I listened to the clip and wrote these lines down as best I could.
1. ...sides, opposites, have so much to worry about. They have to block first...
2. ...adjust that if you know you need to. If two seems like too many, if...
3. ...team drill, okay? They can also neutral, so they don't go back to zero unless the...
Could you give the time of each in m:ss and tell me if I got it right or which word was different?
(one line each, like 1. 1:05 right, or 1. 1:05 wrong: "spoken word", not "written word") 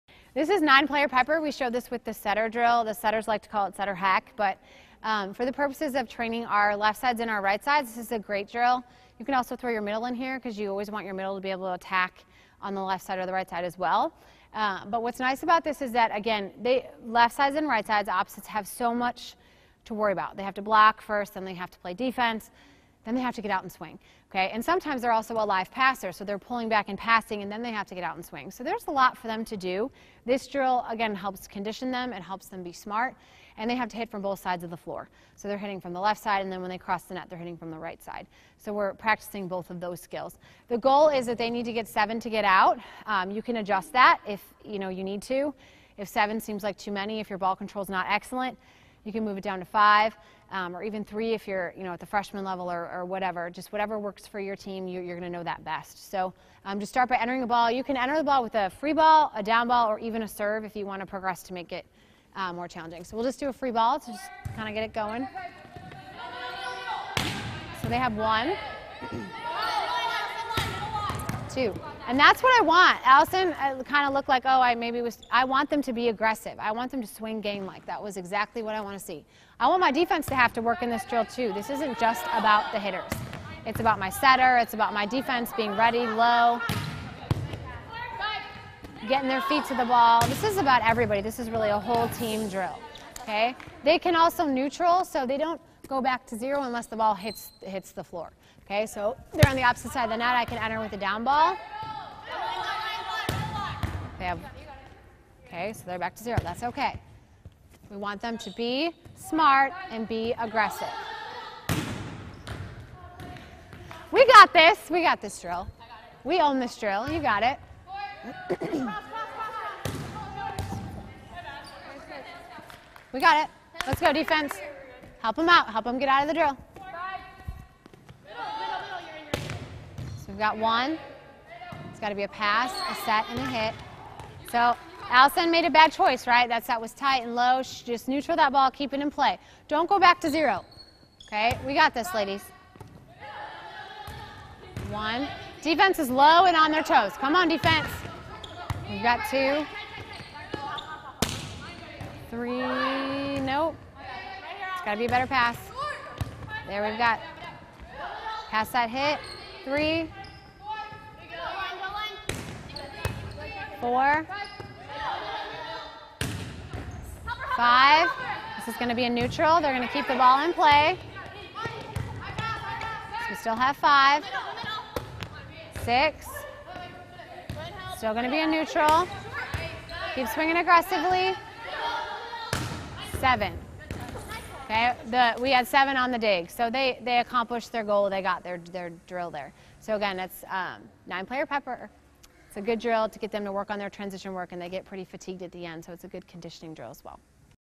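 1. 0:17 right
2. 0:43 wrong: "seven", not "two"
3. 1:32 right.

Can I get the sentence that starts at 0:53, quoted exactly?
Just whatever works for your team, you, are going to know that best.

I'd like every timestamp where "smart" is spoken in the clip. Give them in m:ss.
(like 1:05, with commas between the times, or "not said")
0:32, 1:49.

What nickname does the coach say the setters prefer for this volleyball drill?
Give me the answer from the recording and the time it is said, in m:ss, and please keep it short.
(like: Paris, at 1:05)
setter hack, at 0:03.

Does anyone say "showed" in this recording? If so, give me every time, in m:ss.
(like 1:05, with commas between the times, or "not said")
0:01.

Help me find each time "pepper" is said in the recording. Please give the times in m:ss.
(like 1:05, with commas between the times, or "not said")
0:01, 3:11.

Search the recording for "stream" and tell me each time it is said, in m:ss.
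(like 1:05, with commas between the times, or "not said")
not said.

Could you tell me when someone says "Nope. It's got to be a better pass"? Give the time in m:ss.
2:33.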